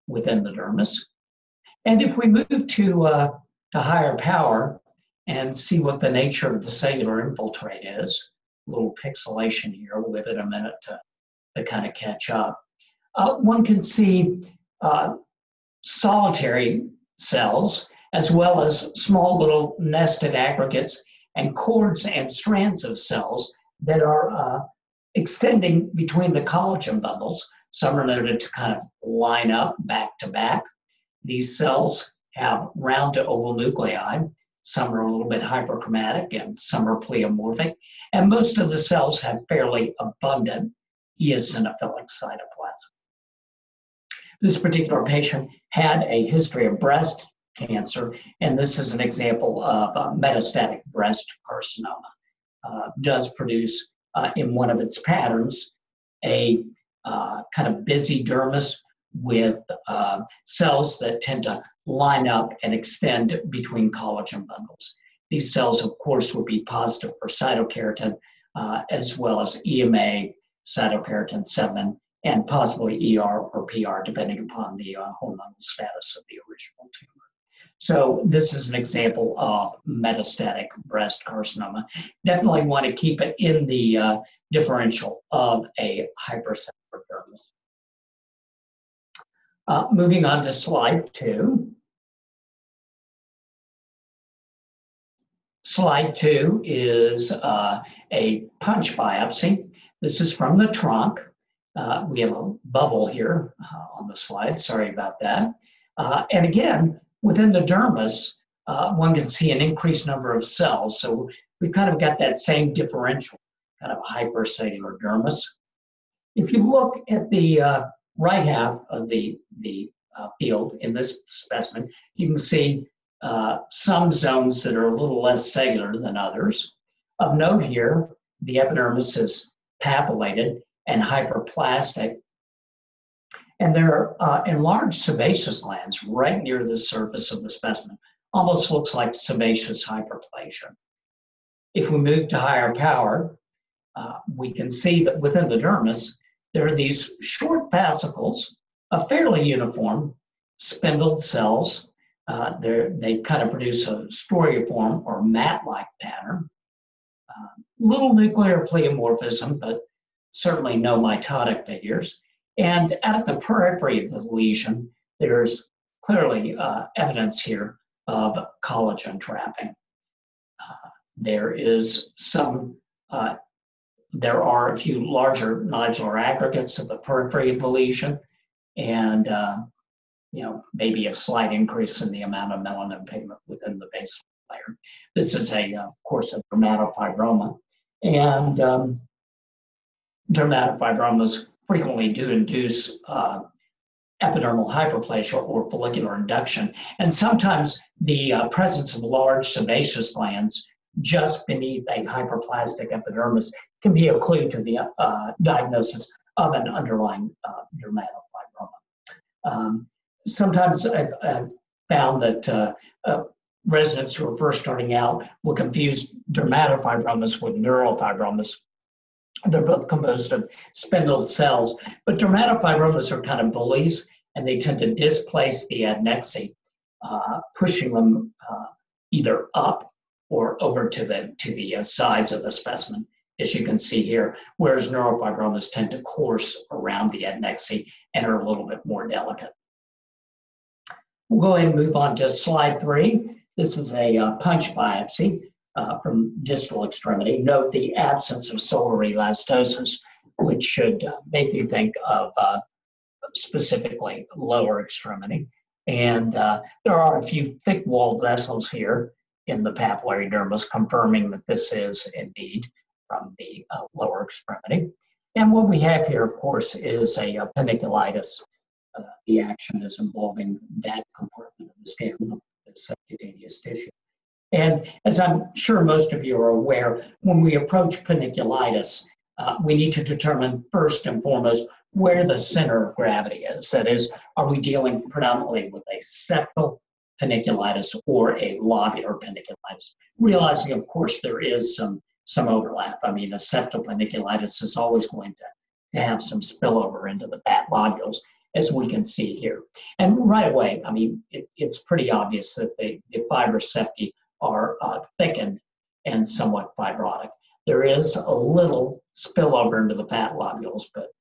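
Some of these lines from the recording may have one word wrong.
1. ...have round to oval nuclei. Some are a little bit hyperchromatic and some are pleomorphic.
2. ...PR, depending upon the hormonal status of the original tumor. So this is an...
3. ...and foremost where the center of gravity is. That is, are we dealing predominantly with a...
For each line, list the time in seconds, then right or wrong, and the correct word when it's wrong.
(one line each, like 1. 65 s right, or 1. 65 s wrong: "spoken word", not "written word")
1. 32 s right
2. 73 s right
3. 281 s right.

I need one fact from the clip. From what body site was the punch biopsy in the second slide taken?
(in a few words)
Trunk.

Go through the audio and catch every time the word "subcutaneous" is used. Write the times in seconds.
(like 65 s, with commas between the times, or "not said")
272 s.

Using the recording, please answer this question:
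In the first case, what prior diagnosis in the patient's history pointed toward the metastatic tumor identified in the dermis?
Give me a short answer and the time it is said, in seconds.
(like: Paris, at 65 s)
Breast cancer, at 46 s.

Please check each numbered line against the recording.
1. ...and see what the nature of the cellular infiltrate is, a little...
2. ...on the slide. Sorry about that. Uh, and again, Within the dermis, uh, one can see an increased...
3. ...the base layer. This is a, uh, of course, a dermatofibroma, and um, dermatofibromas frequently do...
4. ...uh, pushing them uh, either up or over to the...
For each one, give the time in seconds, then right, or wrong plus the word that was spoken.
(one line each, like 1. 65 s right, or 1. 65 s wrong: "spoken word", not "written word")
1. 5 s right
2. 103 s right
3. 183 s right
4. 227 s right.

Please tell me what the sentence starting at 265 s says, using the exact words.
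And what we have here, of course, is a, a panniculitis.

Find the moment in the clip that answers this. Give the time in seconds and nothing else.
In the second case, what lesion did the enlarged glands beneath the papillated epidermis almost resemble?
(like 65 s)
139 s.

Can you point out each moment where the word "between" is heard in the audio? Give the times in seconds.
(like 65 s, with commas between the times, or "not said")
25 s, 63 s.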